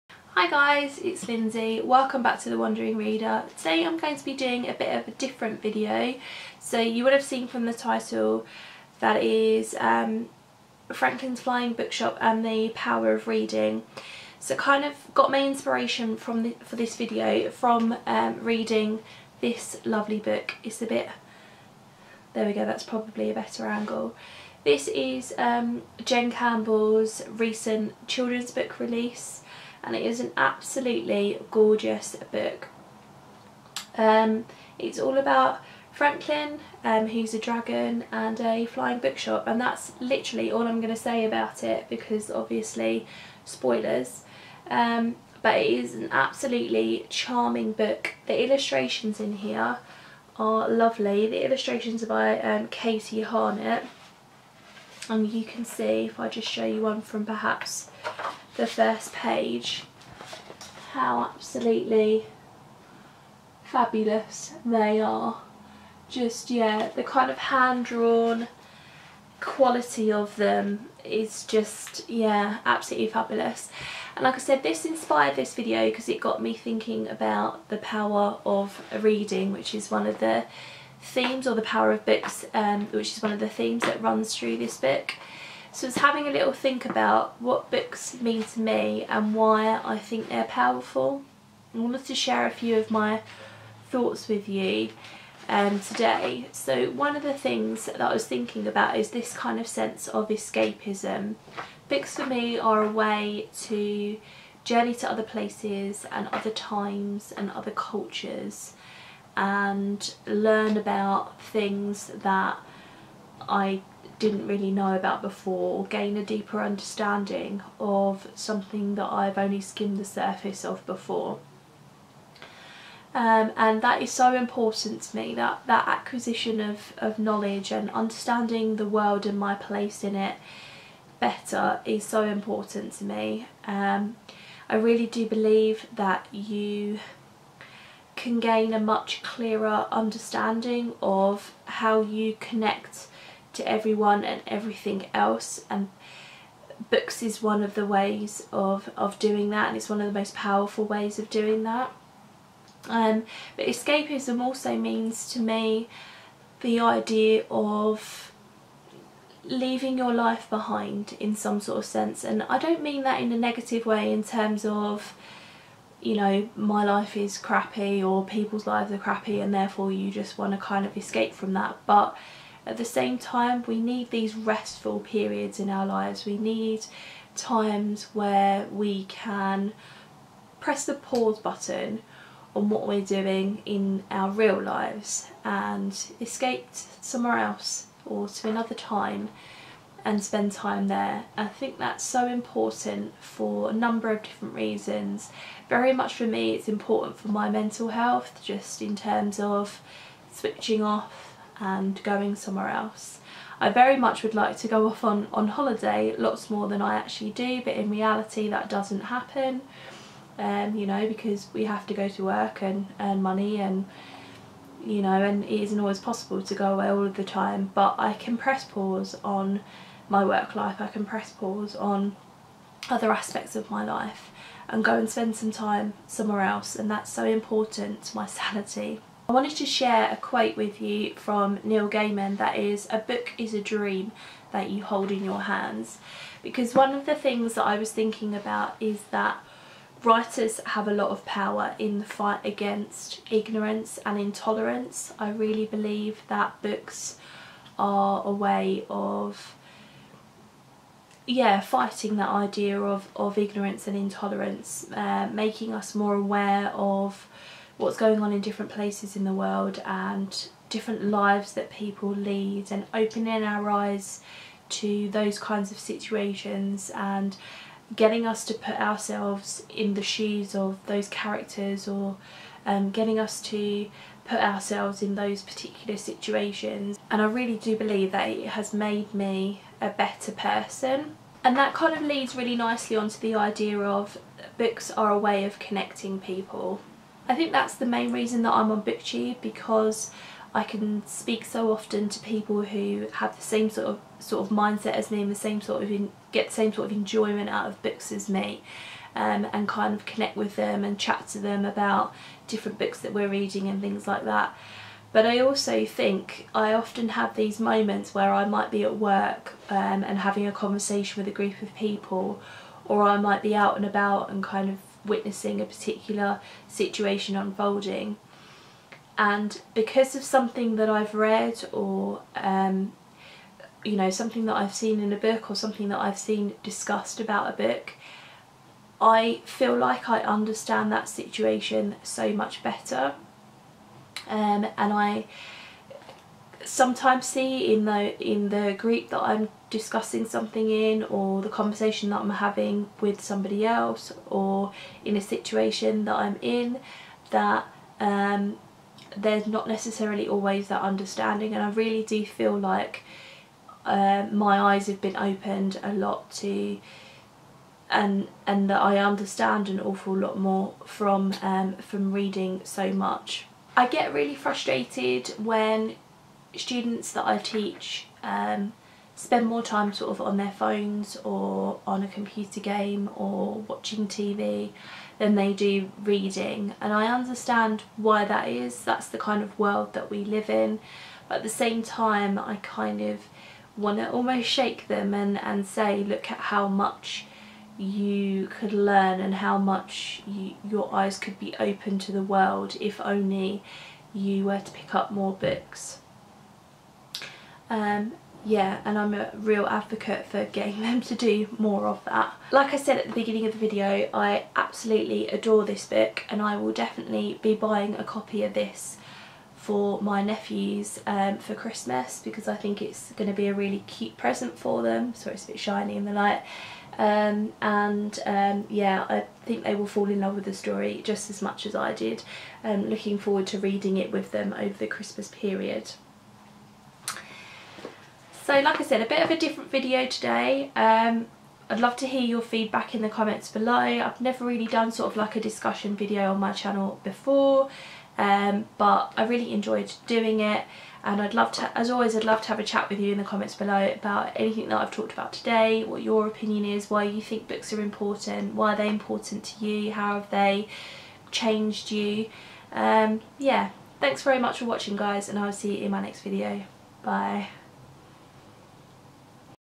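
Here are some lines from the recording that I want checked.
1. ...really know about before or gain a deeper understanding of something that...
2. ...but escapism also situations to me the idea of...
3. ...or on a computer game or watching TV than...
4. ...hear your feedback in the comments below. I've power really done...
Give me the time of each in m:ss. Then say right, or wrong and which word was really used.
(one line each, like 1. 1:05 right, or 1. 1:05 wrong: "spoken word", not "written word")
1. 1:54 right
2. 2:33 wrong: "means", not "situations"
3. 6:11 right
4. 7:12 wrong: "never", not "power".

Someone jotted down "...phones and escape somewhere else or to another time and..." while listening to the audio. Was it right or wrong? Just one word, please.
wrong.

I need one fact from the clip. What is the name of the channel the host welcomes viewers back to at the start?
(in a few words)
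The Wandering Reader.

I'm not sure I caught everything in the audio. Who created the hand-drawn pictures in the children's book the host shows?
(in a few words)
Katie Harnett.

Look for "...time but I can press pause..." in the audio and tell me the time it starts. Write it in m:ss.
3:37.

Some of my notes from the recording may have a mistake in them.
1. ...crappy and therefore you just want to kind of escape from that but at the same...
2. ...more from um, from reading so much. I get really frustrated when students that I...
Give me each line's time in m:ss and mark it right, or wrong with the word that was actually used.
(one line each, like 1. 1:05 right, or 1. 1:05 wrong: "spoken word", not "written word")
1. 2:48 right
2. 6:00 right.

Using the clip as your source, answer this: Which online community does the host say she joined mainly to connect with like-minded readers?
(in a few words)
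BookTube.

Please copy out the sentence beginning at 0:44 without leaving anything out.
Um, but it is an absolutely charming book.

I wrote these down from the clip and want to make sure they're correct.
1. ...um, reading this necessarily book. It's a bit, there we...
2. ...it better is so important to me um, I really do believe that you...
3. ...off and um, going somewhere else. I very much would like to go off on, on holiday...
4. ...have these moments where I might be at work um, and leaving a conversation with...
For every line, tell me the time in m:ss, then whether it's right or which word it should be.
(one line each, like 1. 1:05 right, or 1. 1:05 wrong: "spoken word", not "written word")
1. 0:18 wrong: "lovely", not "necessarily"
2. 2:10 right
3. 3:20 right
4. 5:07 wrong: "having", not "leaving".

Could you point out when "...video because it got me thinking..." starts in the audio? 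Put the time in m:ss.
1:15.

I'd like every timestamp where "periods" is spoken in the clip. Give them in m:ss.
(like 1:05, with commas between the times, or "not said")
2:54, 7:05.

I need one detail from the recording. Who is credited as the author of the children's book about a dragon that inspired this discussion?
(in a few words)
Jen Campbell.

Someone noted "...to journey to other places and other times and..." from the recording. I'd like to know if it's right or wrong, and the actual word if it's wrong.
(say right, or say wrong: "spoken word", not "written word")
right.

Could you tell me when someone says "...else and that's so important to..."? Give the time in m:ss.
3:46.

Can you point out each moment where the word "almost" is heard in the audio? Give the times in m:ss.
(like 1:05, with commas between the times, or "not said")
6:24.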